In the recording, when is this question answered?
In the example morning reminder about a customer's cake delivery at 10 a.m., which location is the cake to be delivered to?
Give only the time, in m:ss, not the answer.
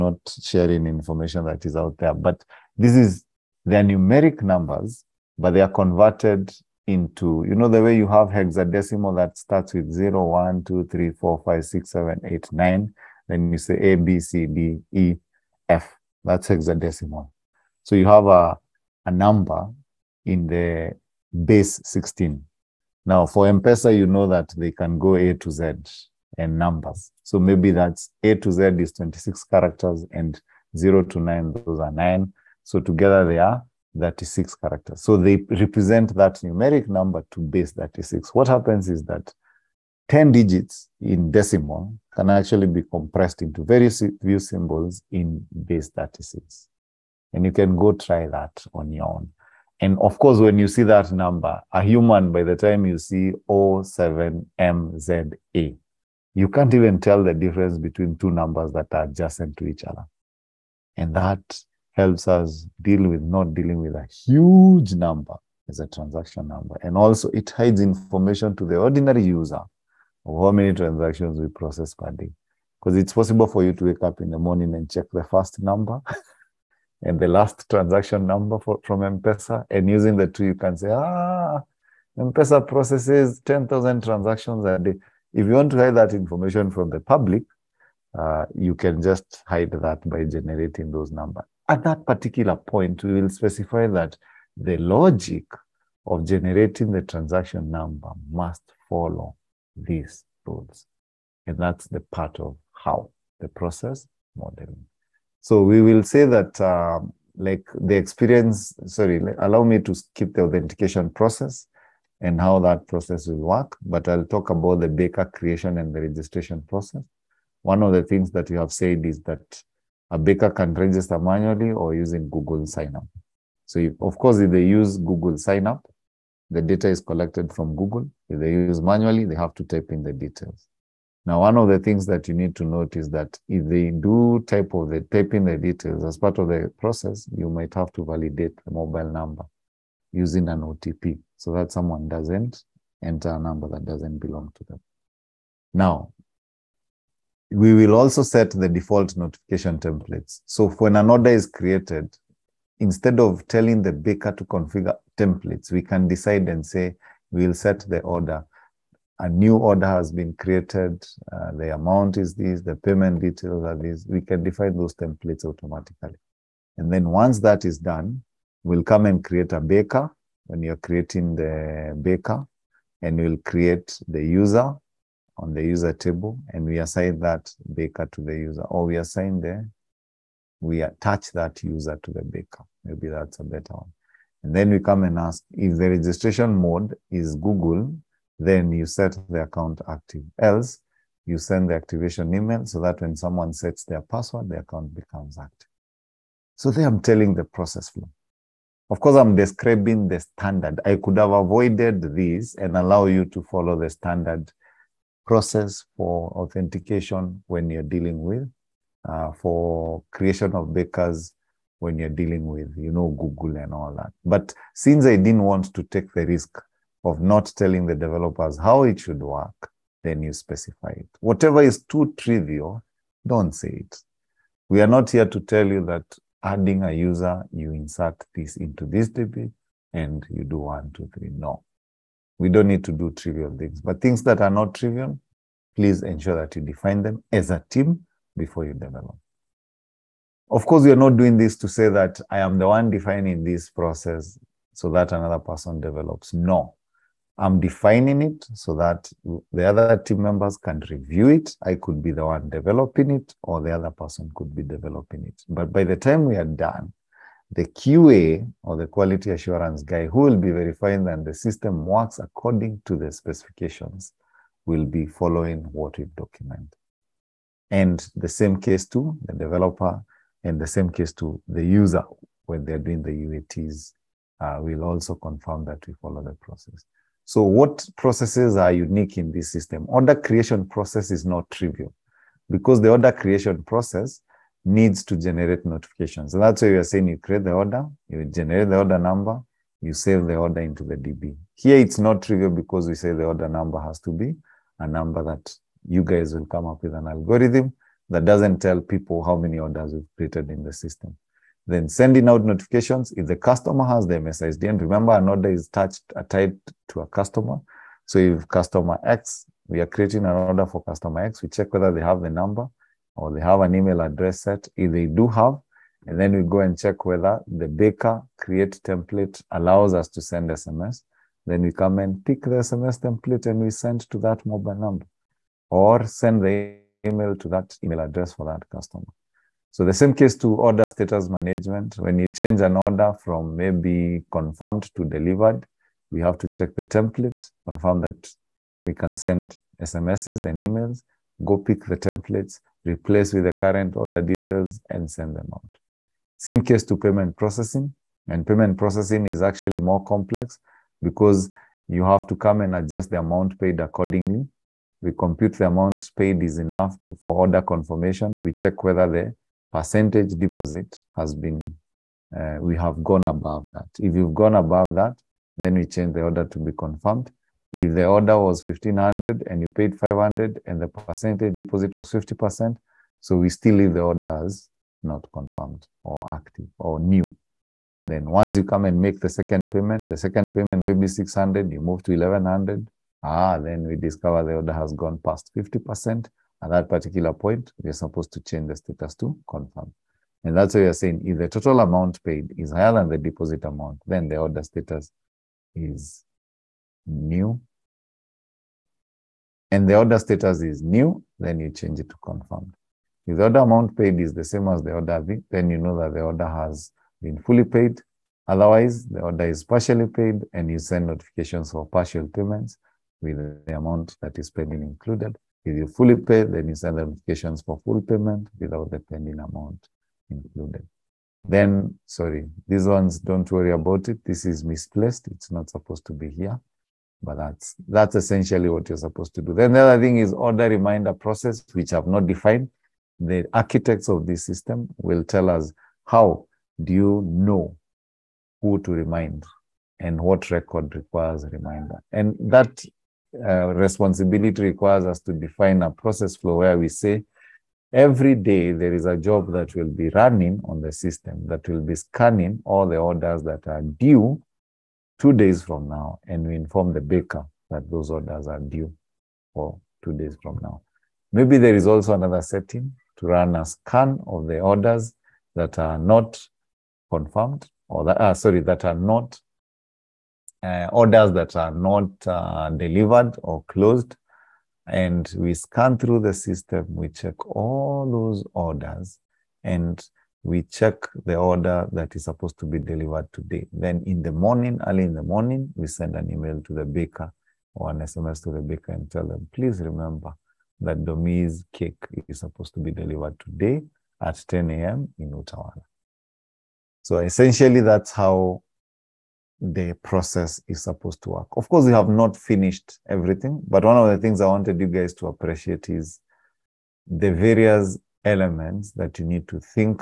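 8:15.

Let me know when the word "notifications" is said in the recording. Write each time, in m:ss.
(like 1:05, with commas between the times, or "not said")
2:29, 4:45, 5:02, 6:51, 6:57.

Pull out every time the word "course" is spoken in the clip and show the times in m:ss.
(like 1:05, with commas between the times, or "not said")
0:50, 2:04, 3:18, 4:00, 8:21.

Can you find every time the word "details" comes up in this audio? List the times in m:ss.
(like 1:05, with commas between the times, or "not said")
2:10, 2:15, 2:43, 5:44.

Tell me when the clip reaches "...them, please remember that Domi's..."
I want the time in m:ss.
8:09.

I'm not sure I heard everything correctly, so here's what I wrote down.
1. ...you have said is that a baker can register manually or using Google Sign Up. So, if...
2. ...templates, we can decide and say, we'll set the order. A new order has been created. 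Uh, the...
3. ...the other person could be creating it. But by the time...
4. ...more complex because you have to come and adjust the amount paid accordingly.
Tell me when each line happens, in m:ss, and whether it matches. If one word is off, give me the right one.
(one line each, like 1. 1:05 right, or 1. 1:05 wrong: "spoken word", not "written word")
1. 1:58 right
2. 2:35 right
3. 4:13 wrong: "developing", not "creating"
4. 5:49 right.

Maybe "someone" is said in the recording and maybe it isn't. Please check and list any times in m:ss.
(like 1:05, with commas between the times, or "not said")
2:21, 3:13.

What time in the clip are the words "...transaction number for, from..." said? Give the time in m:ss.
1:17.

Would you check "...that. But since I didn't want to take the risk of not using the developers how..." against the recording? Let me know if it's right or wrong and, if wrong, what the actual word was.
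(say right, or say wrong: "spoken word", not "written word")
wrong: "telling", not "using".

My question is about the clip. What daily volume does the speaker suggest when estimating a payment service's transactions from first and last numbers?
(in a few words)
10,000.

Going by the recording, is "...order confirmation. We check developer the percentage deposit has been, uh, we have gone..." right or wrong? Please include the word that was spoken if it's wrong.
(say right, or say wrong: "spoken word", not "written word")
wrong: "whether", not "developer".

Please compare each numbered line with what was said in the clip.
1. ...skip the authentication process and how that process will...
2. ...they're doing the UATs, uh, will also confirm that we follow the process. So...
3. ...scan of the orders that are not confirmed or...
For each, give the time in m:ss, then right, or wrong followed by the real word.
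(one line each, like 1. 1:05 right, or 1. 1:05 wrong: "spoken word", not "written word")
1. 1:49 right
2. 4:32 right
3. 7:43 right.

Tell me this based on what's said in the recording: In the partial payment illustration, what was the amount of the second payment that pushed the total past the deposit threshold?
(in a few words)
600.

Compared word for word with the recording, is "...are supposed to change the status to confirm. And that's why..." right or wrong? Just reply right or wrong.
right.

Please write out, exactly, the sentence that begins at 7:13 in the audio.
The architects of this system will tell us how do you know who to remind and what record requires reminder.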